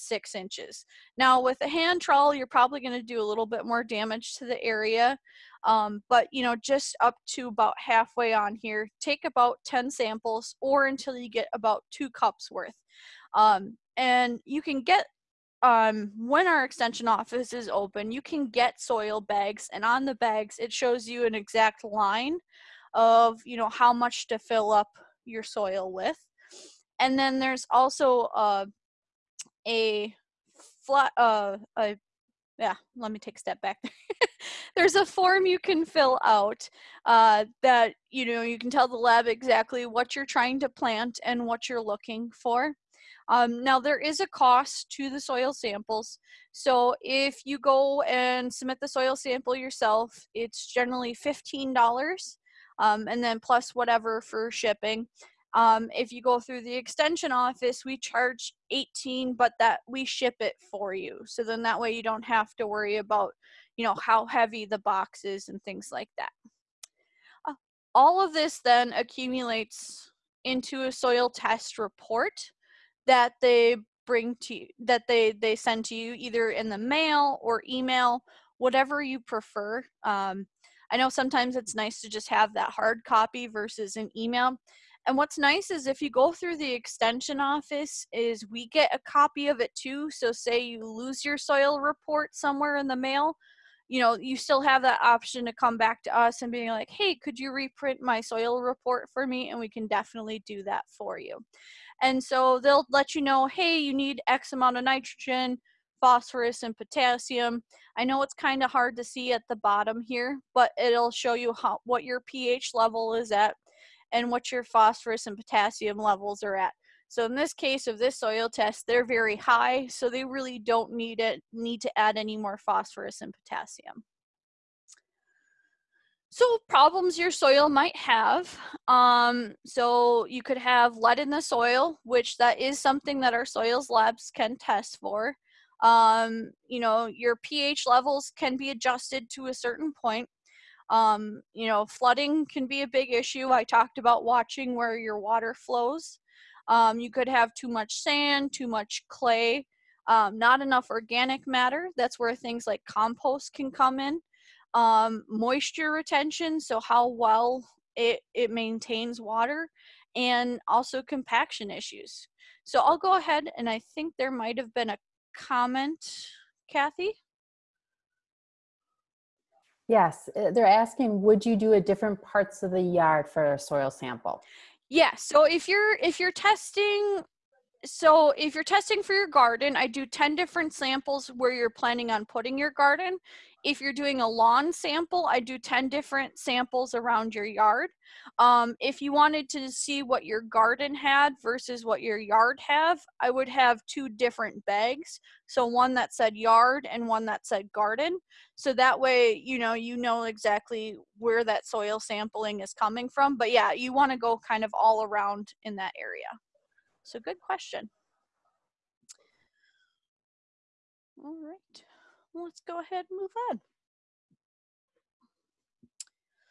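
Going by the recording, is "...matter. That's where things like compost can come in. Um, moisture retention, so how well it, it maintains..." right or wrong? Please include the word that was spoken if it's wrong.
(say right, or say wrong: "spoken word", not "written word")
right.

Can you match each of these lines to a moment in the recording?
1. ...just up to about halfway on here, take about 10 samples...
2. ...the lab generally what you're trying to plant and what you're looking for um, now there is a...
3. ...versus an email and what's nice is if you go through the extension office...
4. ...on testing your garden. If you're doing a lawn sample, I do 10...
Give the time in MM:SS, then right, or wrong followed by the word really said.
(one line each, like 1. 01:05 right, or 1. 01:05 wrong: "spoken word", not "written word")
1. 00:06 right
2. 00:38 wrong: "exactly", not "generally"
3. 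01:23 right
4. 03:02 wrong: "putting", not "testing".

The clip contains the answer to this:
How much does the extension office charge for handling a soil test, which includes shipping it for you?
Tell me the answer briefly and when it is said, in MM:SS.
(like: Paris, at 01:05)
$18, at 00:58.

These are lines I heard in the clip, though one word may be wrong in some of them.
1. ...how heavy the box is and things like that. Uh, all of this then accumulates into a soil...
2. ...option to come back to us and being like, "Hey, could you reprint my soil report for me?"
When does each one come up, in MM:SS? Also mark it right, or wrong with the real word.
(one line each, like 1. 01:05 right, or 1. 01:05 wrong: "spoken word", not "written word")
1. 01:03 right
2. 01:35 right.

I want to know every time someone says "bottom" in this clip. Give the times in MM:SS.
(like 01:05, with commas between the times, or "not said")
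01:49.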